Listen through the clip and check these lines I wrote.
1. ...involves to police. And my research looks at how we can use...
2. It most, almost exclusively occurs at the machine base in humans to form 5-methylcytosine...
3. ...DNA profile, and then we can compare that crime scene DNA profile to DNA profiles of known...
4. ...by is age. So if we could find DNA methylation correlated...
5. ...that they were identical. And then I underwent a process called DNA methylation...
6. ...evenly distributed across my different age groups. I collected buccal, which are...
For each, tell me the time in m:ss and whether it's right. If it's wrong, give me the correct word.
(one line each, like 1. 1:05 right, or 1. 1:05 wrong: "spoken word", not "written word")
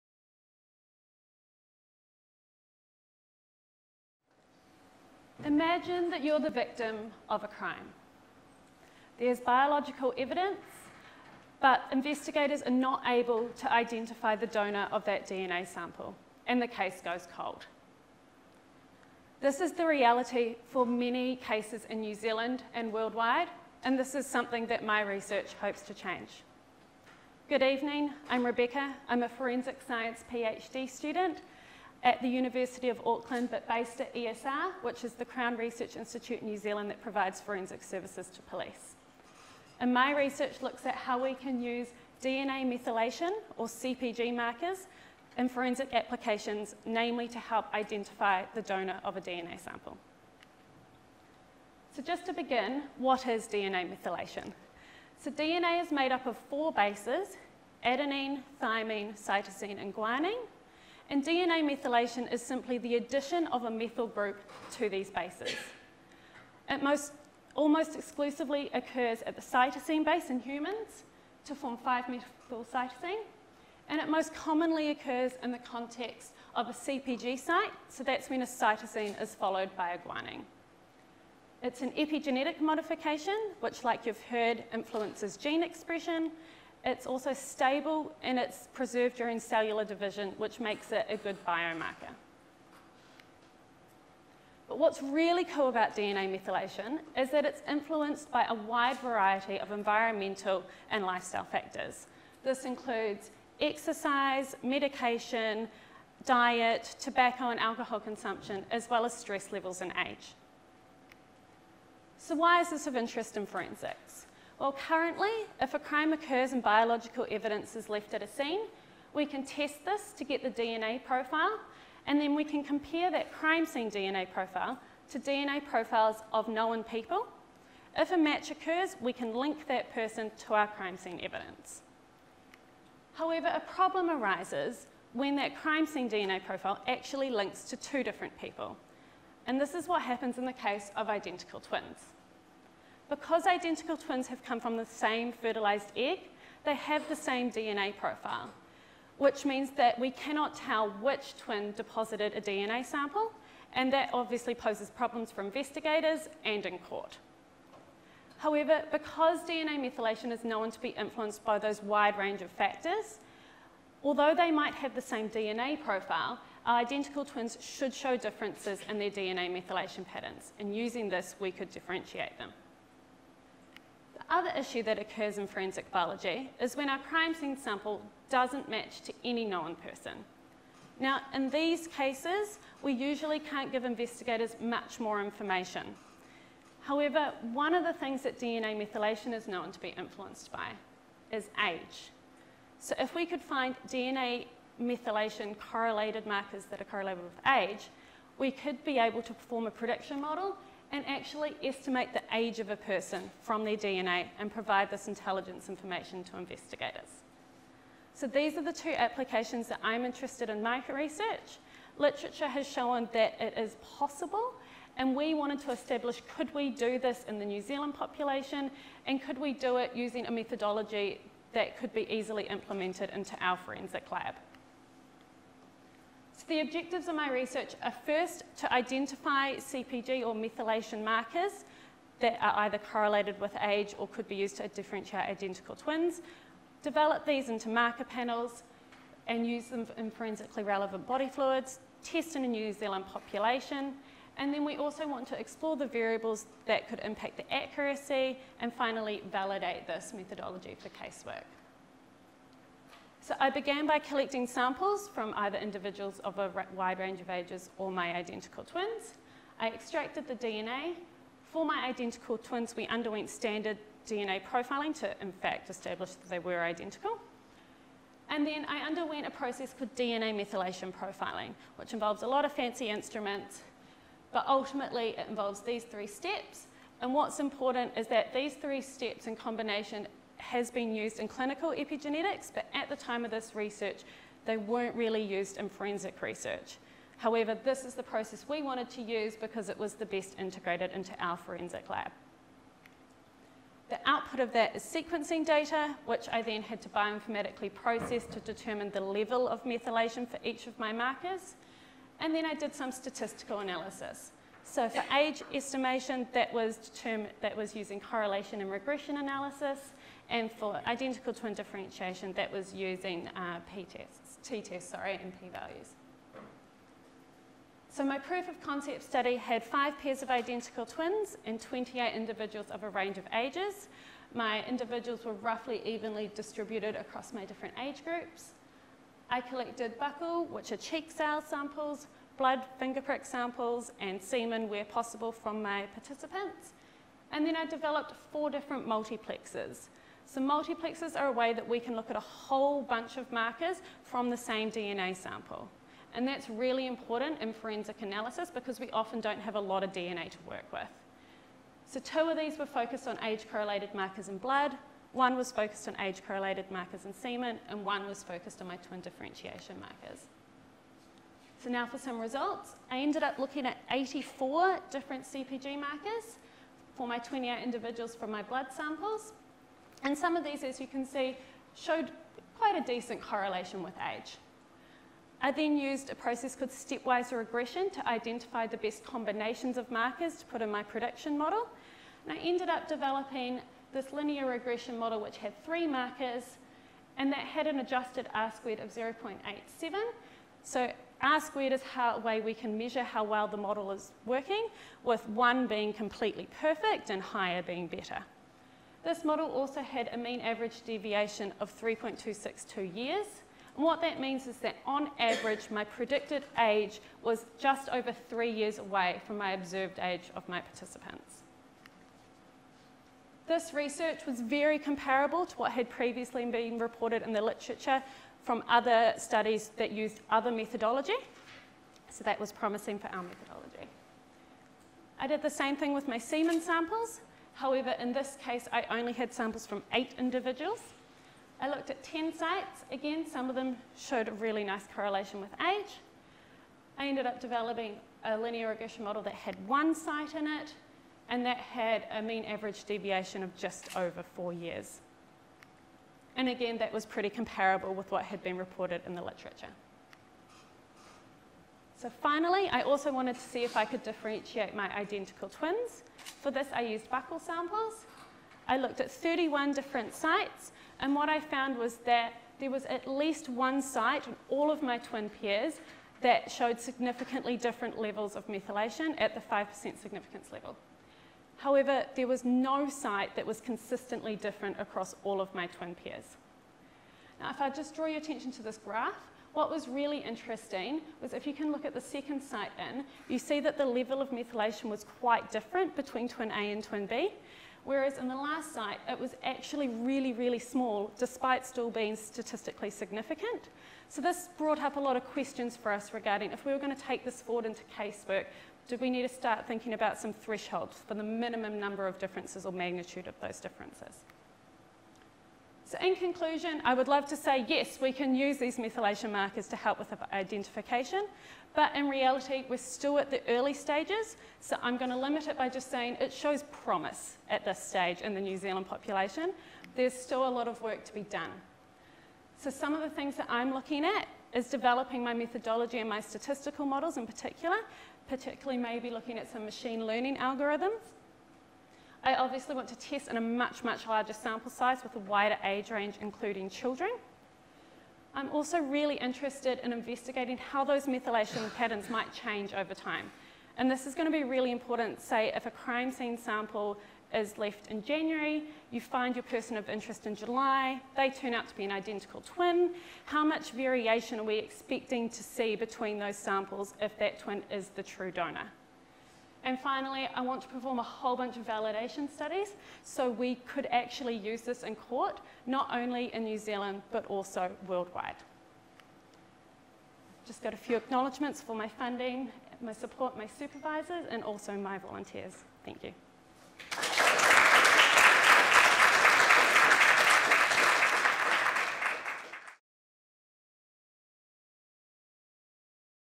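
1. 0:37 wrong: "services", not "involves"
2. 1:06 wrong: "cytosine", not "machine"
3. 2:00 right
4. 3:10 right
5. 4:26 right
6. 5:25 right.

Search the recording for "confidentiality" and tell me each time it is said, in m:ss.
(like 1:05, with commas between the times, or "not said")
not said.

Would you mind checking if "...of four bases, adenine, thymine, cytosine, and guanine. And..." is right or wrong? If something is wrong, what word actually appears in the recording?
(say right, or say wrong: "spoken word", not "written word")
right.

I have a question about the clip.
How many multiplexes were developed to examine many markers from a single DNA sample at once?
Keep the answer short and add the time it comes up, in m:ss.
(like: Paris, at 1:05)
4, at 5:38.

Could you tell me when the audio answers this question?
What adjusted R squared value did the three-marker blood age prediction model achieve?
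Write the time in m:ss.
6:28.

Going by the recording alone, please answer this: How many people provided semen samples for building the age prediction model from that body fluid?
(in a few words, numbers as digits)
8.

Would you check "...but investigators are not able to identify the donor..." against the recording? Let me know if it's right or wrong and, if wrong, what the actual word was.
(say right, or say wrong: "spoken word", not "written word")
right.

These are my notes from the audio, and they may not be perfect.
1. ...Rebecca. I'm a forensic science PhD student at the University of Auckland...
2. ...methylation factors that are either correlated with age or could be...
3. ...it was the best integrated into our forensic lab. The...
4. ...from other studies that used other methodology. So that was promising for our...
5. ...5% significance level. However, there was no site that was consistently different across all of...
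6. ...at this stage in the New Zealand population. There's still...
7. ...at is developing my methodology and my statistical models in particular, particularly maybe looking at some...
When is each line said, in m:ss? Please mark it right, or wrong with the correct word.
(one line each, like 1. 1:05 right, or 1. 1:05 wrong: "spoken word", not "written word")
1. 0:28 right
2. 3:50 wrong: "markers", not "factors"
3. 4:49 right
4. 6:58 right
5. 7:49 right
6. 8:37 right
7. 8:44 right.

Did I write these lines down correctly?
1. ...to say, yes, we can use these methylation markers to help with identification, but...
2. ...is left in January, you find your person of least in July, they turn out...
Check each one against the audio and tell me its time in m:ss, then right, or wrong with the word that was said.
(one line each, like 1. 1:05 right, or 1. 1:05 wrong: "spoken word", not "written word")
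1. 8:27 right
2. 9:07 wrong: "interest", not "least".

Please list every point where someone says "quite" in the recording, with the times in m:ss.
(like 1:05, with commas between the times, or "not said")
6:12, 8:05.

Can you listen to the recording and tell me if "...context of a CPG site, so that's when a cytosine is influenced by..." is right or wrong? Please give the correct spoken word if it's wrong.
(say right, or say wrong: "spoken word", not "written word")
wrong: "followed", not "influenced".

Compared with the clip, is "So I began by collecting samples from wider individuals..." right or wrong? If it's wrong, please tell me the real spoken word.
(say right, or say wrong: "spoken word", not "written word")
wrong: "either", not "wider".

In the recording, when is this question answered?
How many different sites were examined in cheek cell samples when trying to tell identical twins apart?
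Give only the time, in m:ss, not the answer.
7:39.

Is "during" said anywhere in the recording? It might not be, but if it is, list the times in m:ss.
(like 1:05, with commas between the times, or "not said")
1:29.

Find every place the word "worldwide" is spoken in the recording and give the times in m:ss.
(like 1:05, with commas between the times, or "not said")
0:22, 9:27.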